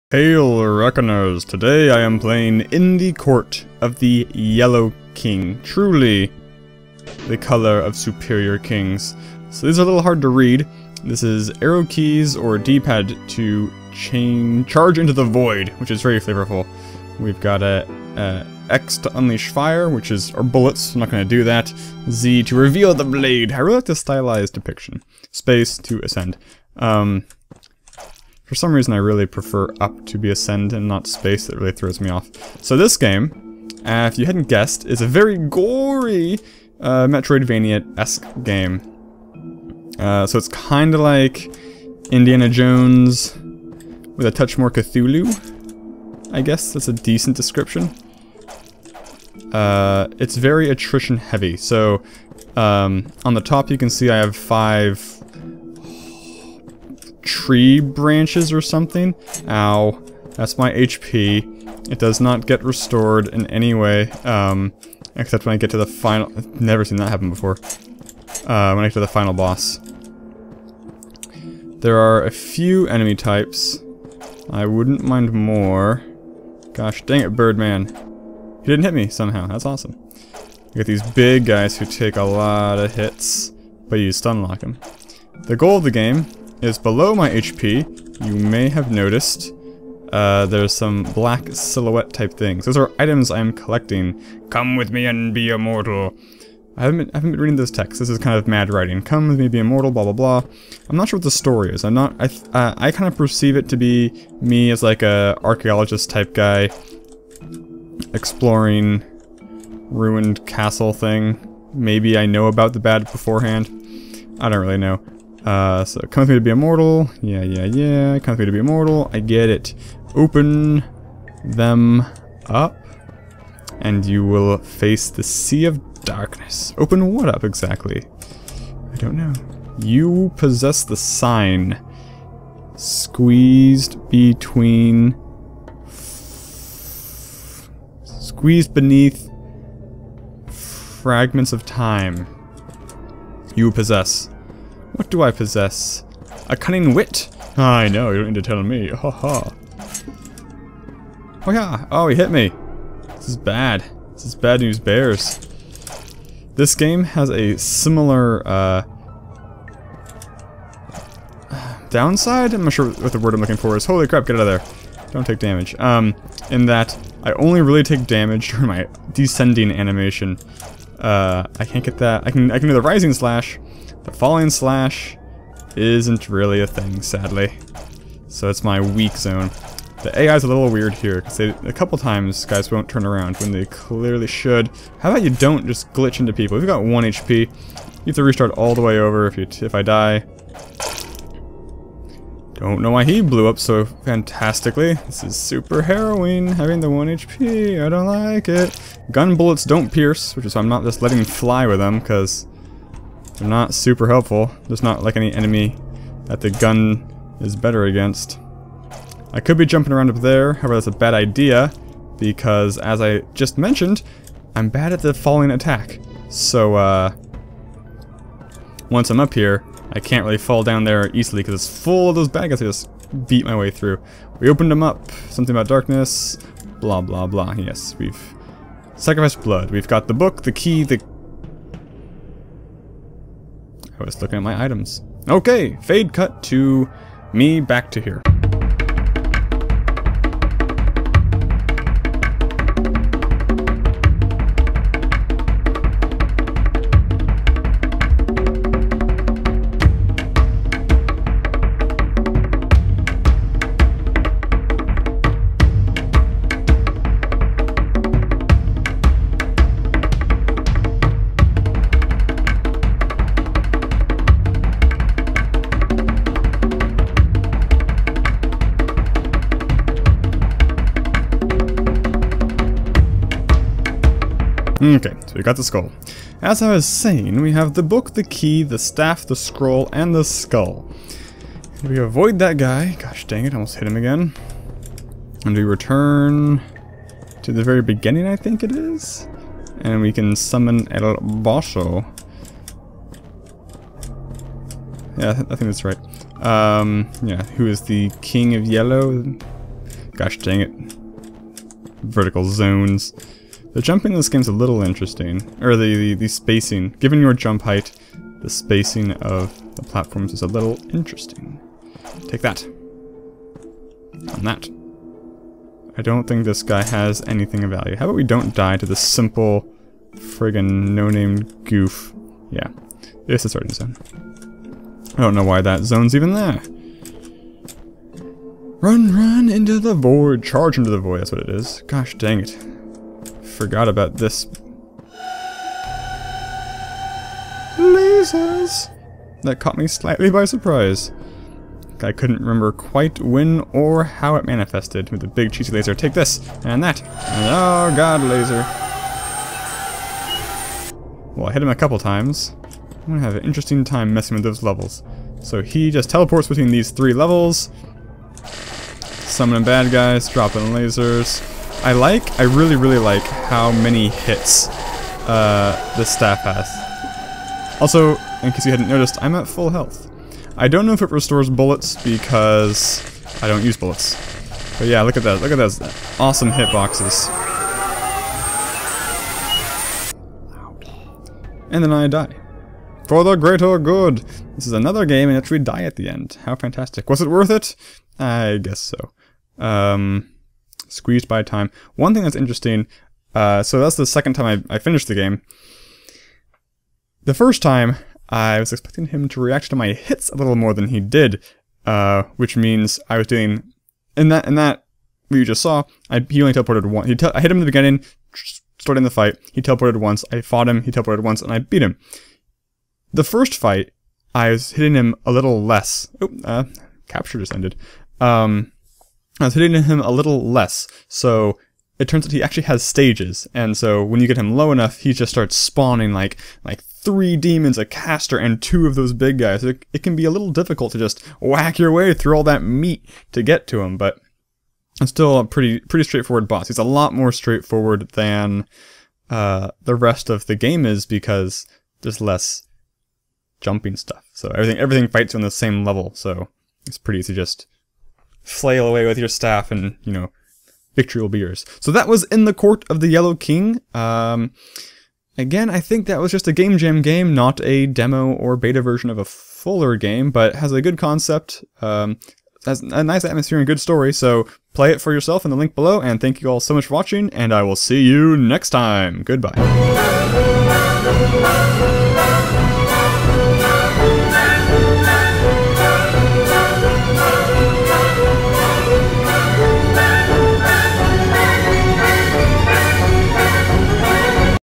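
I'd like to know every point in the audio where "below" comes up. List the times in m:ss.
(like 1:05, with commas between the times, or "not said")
1:26, 7:45.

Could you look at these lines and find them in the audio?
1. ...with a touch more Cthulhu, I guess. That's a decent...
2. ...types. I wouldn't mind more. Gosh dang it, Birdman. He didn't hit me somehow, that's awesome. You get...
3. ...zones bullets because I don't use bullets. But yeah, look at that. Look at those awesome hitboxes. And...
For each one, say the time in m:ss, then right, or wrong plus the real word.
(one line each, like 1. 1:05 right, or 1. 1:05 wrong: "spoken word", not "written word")
1. 0:44 right
2. 1:13 right
3. 6:11 wrong: "restores", not "zones".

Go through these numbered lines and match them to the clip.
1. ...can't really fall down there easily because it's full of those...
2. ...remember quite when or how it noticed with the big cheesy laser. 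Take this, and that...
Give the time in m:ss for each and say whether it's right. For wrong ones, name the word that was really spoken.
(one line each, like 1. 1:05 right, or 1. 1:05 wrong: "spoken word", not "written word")
1. 3:39 right
2. 5:42 wrong: "manifested", not "noticed".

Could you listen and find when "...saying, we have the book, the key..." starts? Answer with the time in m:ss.
4:36.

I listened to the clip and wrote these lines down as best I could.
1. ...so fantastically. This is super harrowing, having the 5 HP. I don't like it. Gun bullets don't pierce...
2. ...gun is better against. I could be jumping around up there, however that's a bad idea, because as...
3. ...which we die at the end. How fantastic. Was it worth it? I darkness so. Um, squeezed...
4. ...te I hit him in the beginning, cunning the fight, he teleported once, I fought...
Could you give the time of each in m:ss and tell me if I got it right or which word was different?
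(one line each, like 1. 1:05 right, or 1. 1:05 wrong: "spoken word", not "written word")
1. 3:13 wrong: "1", not "5"
2. 3:26 right
3. 6:25 wrong: "guess", not "darkness"
4. 6:47 wrong: "starting", not "cunning".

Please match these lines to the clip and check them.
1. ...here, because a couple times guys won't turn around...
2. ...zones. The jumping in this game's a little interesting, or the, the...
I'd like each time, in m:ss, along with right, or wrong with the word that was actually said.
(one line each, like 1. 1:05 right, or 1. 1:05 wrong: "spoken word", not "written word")
1. 3:00 right
2. 5:02 right.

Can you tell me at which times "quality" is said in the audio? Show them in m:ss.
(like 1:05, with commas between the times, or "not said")
not said.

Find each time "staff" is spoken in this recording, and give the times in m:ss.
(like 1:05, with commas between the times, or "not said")
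4:38, 6:06, 7:29.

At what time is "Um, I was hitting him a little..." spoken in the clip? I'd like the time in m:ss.
6:58.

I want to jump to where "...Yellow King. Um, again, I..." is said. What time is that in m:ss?
7:33.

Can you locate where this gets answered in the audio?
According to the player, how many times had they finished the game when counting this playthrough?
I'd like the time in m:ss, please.
6:34.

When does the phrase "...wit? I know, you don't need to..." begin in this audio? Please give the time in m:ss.
2:26.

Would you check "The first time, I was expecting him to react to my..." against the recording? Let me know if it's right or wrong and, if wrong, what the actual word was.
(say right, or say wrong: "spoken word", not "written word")
right.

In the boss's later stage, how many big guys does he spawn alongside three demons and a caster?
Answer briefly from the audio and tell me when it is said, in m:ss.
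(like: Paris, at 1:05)
2, at 7:08.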